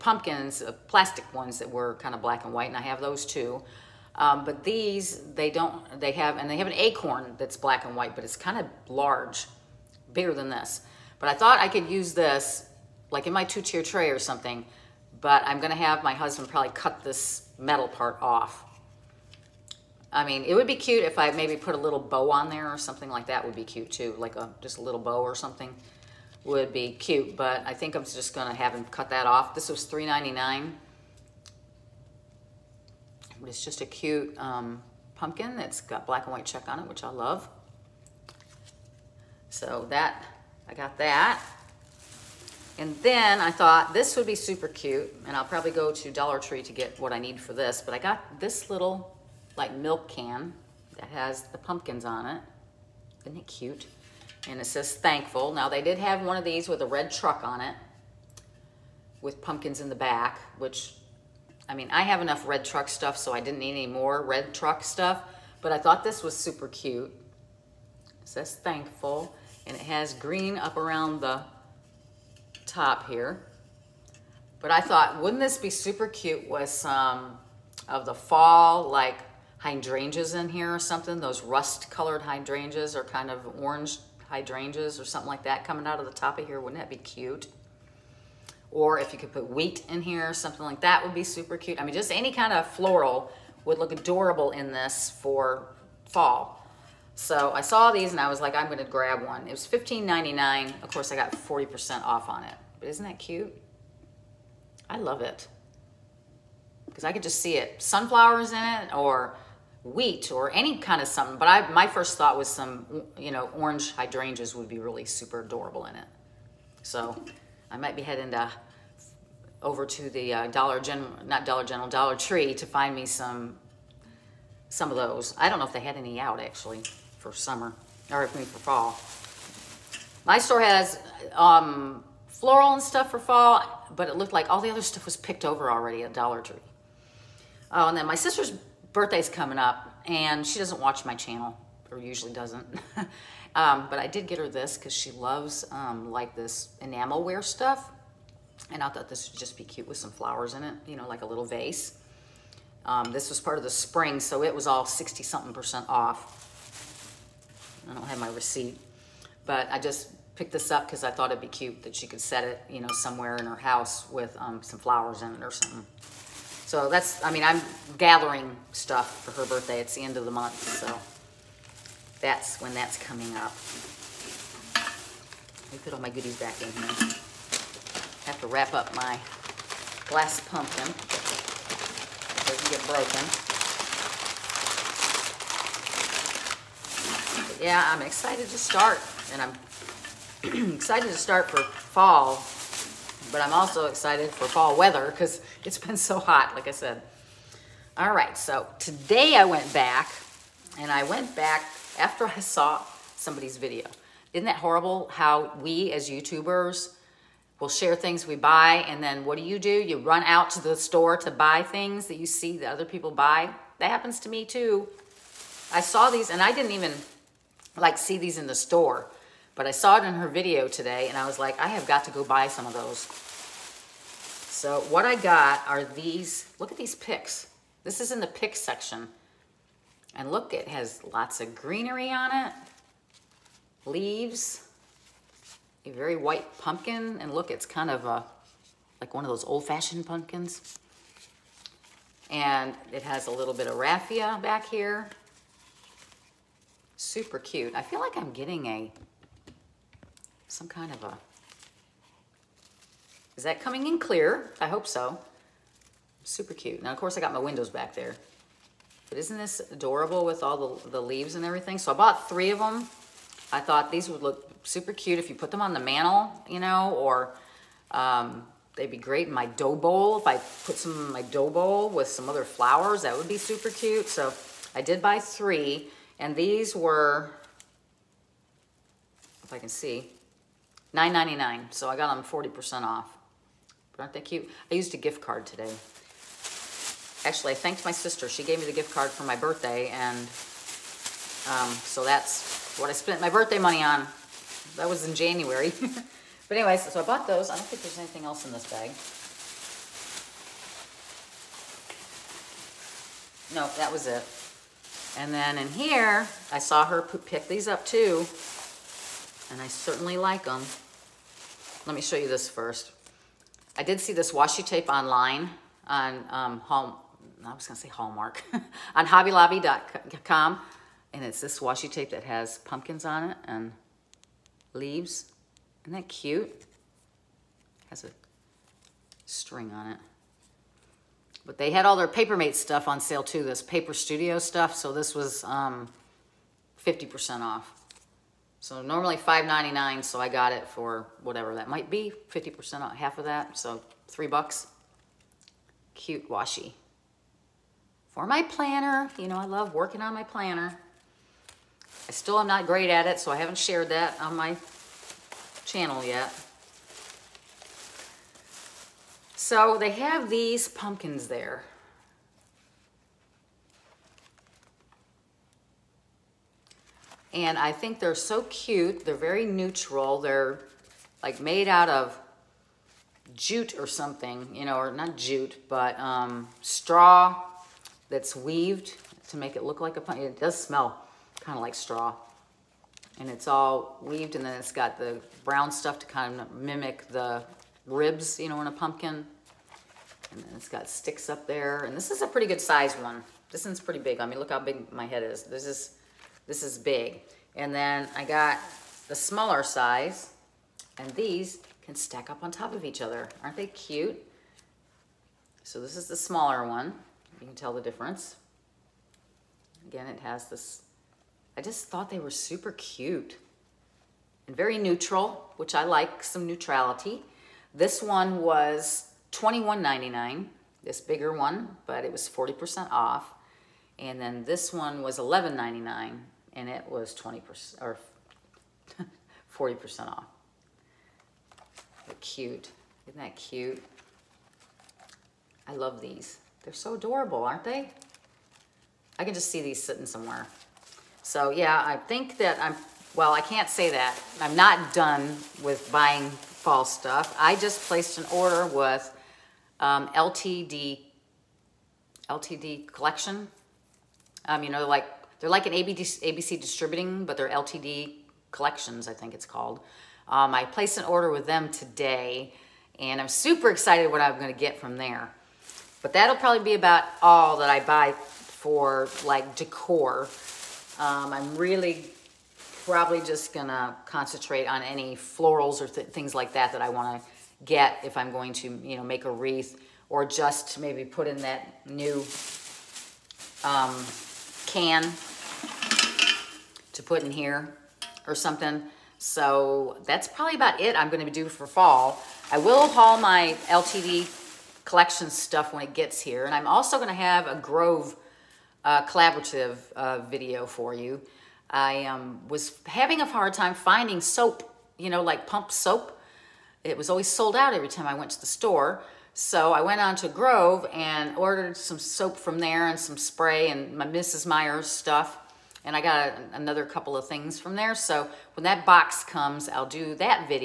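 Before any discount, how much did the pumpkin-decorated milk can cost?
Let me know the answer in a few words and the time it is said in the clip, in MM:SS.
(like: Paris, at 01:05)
$15.99, at 01:39.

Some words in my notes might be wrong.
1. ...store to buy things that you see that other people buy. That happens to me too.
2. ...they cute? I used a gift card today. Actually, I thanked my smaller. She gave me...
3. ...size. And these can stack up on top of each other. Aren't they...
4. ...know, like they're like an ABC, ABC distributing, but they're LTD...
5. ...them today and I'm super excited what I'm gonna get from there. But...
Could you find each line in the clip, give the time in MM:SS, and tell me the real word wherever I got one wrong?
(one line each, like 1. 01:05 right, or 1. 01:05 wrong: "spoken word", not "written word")
1. 03:30 right
2. 04:44 wrong: "sister", not "smaller"
3. 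06:39 right
4. 07:34 right
5. 07:41 right.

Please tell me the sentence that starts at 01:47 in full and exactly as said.
Sunflowers in it or wheat or any kind of something.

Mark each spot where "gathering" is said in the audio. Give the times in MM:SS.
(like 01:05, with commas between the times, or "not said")
02:47.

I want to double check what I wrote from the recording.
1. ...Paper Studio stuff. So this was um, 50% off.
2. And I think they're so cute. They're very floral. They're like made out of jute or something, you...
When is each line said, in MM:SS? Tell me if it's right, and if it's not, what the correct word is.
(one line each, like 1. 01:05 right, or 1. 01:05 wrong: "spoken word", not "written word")
1. 05:33 right
2. 06:07 wrong: "neutral", not "floral".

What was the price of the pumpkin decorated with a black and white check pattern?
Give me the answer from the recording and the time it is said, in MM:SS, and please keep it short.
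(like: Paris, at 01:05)
$3.99, at 00:29.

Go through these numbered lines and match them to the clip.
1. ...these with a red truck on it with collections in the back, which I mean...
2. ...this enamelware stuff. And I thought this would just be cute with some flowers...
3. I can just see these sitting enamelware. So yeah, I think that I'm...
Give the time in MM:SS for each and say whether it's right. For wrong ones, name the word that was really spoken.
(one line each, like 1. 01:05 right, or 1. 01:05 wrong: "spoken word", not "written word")
1. 00:56 wrong: "pumpkins", not "collections"
2. 02:26 right
3. 07:19 wrong: "somewhere", not "enamelware".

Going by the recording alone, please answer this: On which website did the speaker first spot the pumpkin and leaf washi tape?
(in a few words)
hobbylobby.com.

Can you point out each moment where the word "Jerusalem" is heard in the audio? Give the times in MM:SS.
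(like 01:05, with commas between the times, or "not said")
not said.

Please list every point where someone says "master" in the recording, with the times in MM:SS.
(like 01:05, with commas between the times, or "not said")
not said.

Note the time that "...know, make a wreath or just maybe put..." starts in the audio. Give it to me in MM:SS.
07:58.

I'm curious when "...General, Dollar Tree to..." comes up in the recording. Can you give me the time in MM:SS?
02:01.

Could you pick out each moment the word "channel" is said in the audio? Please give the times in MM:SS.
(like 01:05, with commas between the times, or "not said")
02:21, 05:55.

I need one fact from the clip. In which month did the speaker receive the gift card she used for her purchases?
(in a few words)
January.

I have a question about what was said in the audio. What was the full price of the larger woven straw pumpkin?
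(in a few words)
$21.99.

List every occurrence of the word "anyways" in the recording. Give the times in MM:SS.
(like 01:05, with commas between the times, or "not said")
04:56.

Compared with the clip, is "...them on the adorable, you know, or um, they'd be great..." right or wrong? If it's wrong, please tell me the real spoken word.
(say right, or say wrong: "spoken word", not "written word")
wrong: "mantle", not "adorable".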